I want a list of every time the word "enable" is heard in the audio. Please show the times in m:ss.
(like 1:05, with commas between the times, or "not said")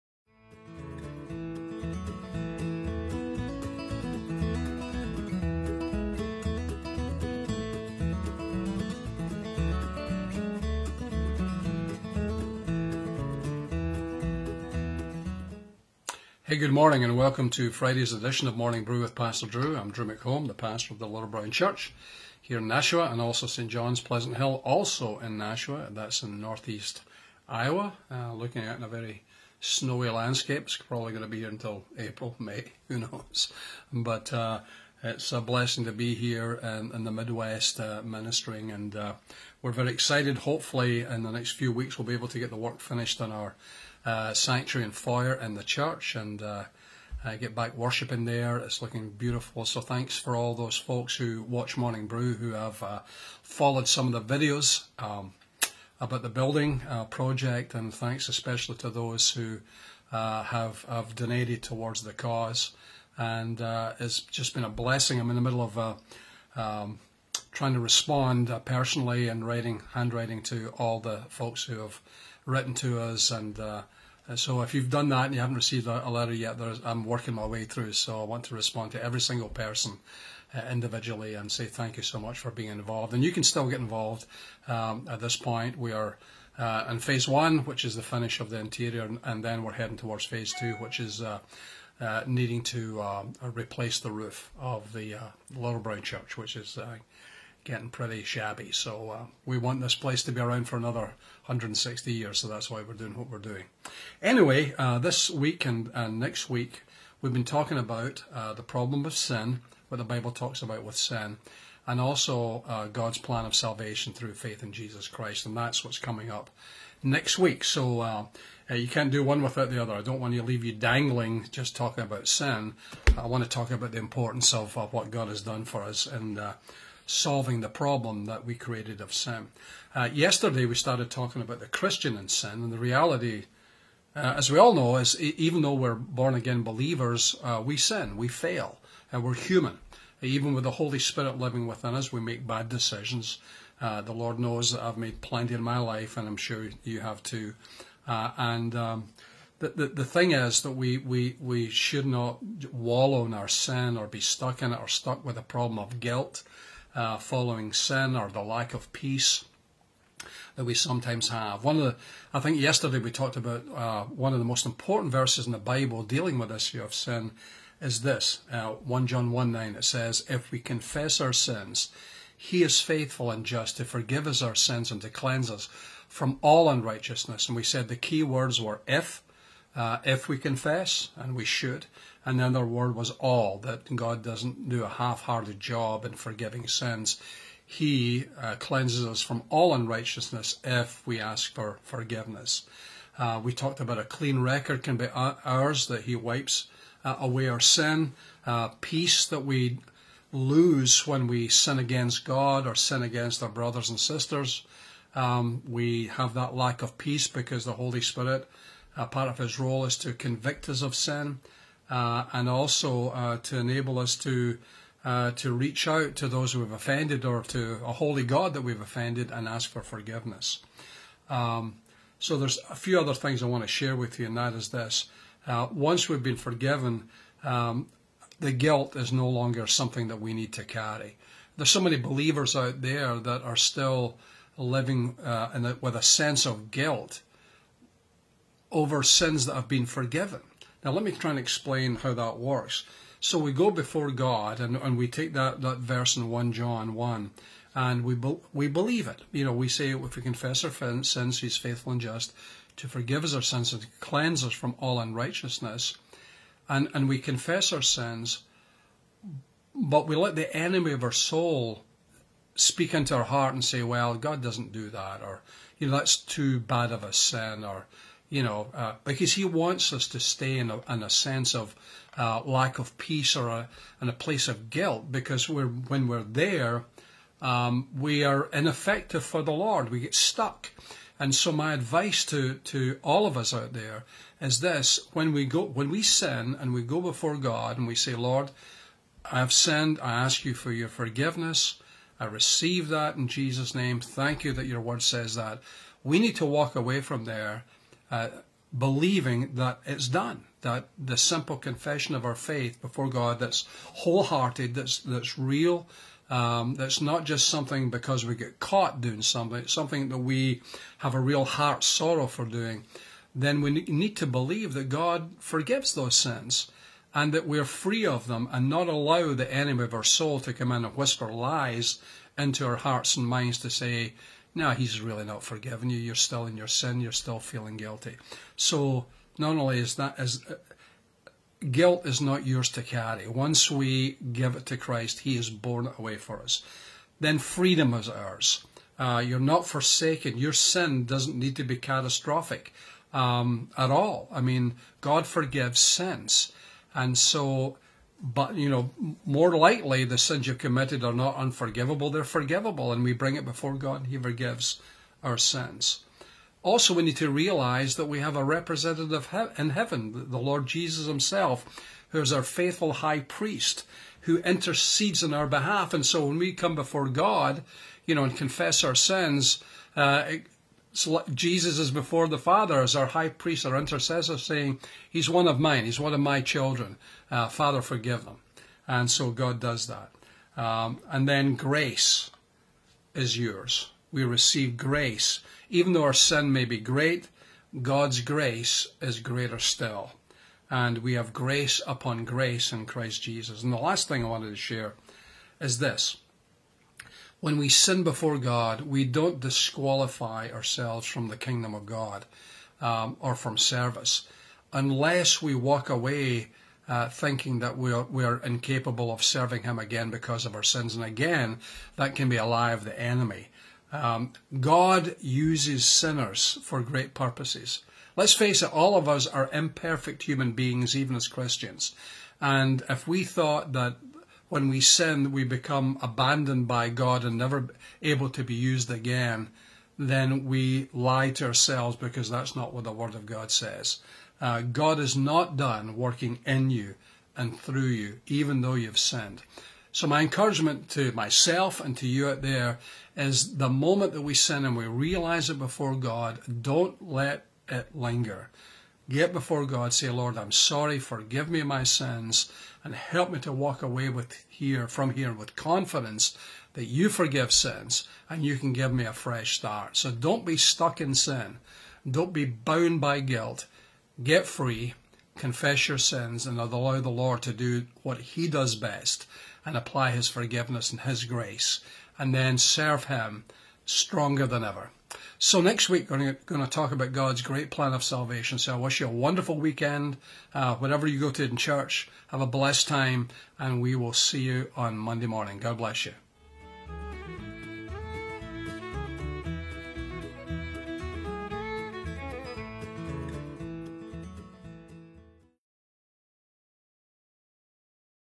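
3:33.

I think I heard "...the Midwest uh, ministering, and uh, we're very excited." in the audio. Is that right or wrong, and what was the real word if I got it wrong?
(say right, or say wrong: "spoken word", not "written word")
right.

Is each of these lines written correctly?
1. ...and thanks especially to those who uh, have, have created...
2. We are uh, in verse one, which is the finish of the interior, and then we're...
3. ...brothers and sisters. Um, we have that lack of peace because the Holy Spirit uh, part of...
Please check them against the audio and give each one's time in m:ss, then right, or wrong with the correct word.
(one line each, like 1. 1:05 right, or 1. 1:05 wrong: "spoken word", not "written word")
1. 0:57 wrong: "donated", not "created"
2. 1:25 wrong: "phase", not "verse"
3. 3:23 right.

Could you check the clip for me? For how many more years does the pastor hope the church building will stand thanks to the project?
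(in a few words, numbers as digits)
160.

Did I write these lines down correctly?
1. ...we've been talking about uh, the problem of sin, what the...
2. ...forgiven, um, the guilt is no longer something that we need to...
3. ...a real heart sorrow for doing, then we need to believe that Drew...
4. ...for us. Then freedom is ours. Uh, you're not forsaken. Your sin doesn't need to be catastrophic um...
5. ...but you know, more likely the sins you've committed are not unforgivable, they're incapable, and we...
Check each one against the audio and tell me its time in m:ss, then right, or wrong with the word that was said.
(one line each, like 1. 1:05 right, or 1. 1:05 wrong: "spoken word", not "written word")
1. 1:47 right
2. 3:46 right
3. 5:11 wrong: "God", not "Drew"
4. 5:36 right
5. 5:48 wrong: "forgivable", not "incapable".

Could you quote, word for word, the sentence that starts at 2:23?
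Uh, the Lord knows that I've made plenty in my life, and I'm sure you have too.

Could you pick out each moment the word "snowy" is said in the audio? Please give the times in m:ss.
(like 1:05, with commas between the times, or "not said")
0:29.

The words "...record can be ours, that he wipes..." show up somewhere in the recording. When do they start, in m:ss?
3:14.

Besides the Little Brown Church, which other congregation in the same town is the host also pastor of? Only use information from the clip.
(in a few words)
St. John's Pleasant Hill.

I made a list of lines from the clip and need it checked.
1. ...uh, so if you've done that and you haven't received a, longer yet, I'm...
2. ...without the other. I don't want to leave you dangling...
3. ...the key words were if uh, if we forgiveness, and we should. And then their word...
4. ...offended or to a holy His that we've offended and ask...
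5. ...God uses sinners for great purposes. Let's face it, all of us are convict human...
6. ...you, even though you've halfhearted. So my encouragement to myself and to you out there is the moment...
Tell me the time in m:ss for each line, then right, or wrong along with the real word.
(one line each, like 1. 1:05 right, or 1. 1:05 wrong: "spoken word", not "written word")
1. 1:13 wrong: "letter", not "longer"
2. 1:59 right
3. 2:57 wrong: "confess", not "forgiveness"
4. 3:36 wrong: "God", not "His"
5. 6:54 wrong: "imperfect", not "convict"
6. 7:17 wrong: "sinned", not "halfhearted".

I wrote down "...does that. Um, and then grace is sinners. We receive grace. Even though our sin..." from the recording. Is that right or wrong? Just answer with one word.
wrong.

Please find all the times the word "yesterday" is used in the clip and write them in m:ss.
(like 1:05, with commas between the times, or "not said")
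2:10, 2:42.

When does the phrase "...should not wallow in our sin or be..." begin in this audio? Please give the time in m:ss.
2:31.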